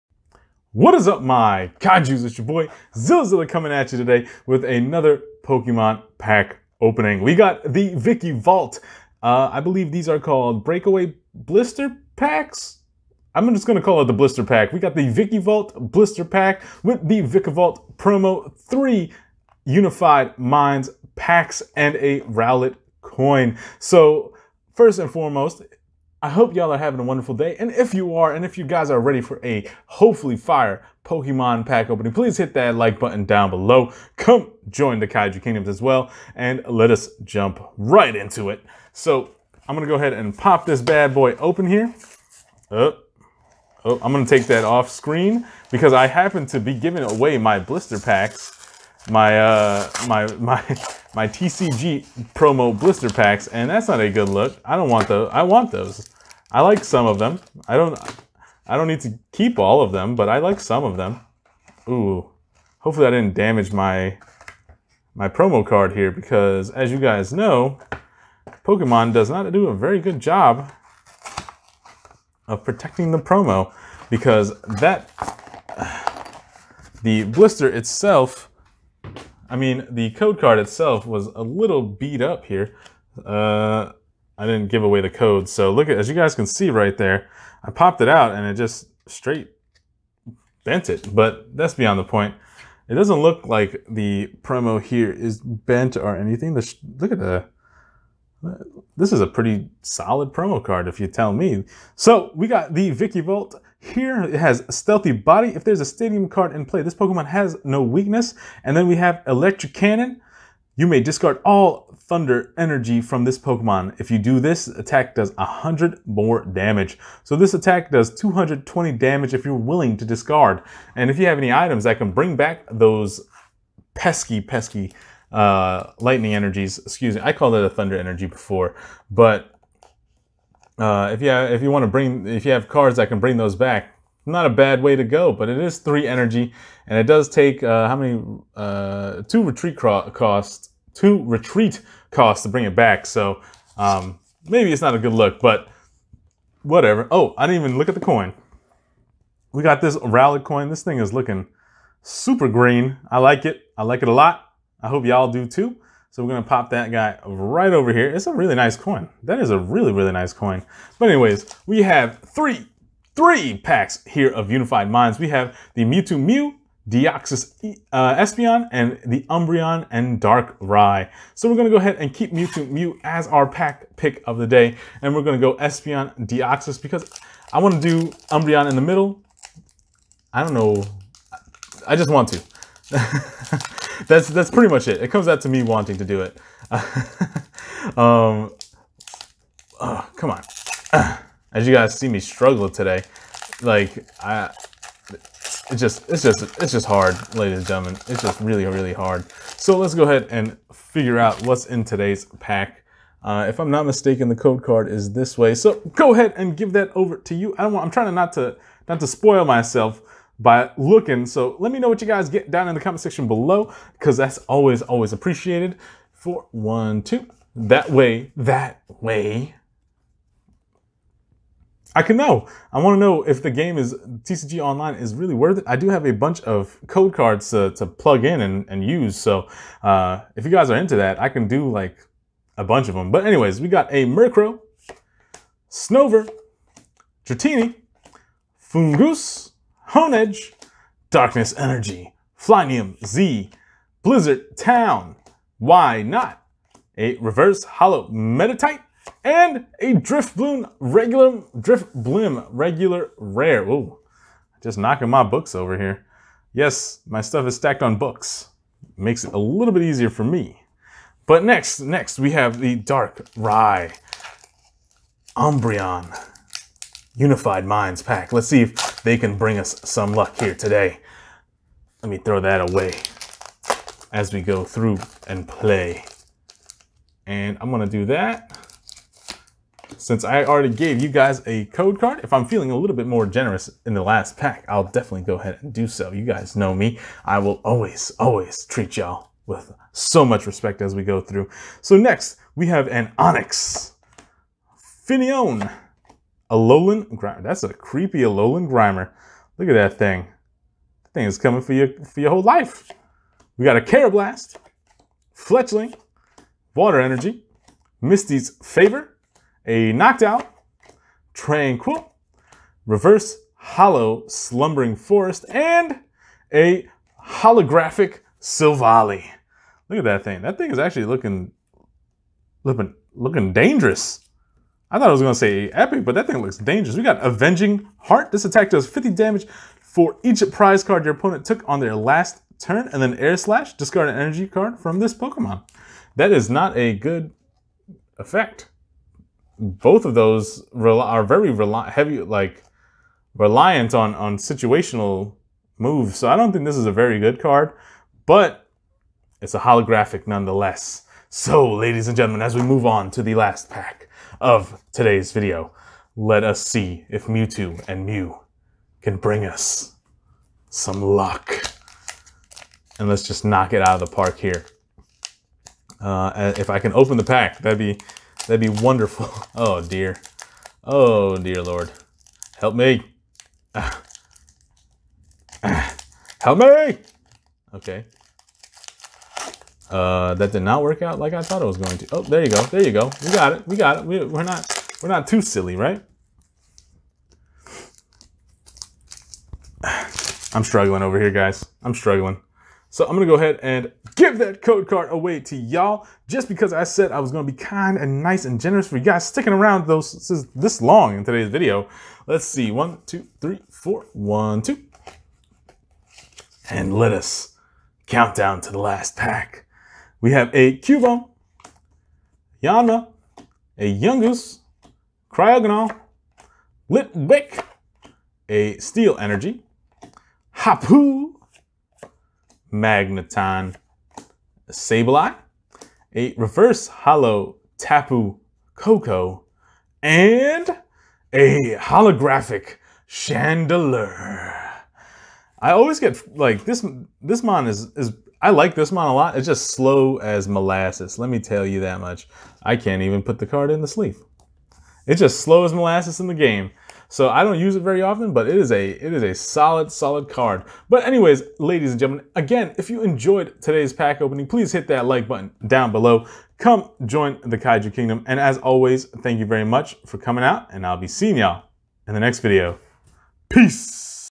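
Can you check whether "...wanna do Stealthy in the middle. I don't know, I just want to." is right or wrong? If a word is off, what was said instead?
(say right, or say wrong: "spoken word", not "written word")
wrong: "Umbreon", not "Stealthy".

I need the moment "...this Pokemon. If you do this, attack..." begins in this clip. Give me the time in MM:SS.
01:53.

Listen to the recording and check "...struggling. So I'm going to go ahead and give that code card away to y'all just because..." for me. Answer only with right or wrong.
right.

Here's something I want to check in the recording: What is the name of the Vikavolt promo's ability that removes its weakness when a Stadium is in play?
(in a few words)
Stealthy Body.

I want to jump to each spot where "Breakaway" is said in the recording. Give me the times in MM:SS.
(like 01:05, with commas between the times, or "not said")
00:10.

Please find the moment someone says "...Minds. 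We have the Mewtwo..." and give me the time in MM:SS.
02:44.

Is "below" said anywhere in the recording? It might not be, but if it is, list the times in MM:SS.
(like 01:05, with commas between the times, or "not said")
00:33, 03:33, 07:35.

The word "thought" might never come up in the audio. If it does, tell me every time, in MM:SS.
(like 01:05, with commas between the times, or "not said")
05:24, 06:21.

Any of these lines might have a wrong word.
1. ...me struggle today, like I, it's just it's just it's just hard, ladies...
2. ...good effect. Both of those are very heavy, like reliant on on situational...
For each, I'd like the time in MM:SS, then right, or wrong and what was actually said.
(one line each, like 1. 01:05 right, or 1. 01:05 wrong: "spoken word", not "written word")
1. 03:12 right
2. 05:36 right.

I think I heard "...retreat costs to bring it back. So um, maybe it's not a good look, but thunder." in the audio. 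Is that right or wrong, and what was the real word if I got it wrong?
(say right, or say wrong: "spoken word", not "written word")
wrong: "whatever", not "thunder".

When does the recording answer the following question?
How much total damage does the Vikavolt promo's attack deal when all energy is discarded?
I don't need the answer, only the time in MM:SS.
01:58.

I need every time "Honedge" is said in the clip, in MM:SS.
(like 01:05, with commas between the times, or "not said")
03:59.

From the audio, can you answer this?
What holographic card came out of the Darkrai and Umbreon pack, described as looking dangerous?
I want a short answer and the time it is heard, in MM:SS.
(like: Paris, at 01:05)
Silvally, at 05:17.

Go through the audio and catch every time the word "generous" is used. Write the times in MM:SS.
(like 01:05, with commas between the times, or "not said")
04:43, 06:38.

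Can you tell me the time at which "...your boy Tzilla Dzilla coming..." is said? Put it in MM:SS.
00:02.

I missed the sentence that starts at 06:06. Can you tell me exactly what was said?
Uh, if I can open the pack, that'd be that'd be wonderful.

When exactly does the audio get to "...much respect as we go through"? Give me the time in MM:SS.
04:50.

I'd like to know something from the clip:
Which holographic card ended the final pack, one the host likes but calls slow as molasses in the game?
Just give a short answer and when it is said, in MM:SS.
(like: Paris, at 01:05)
Chandelure, at 07:11.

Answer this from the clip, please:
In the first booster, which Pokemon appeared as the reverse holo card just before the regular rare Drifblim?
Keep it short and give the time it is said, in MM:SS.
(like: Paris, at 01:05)
Meditite, at 04:07.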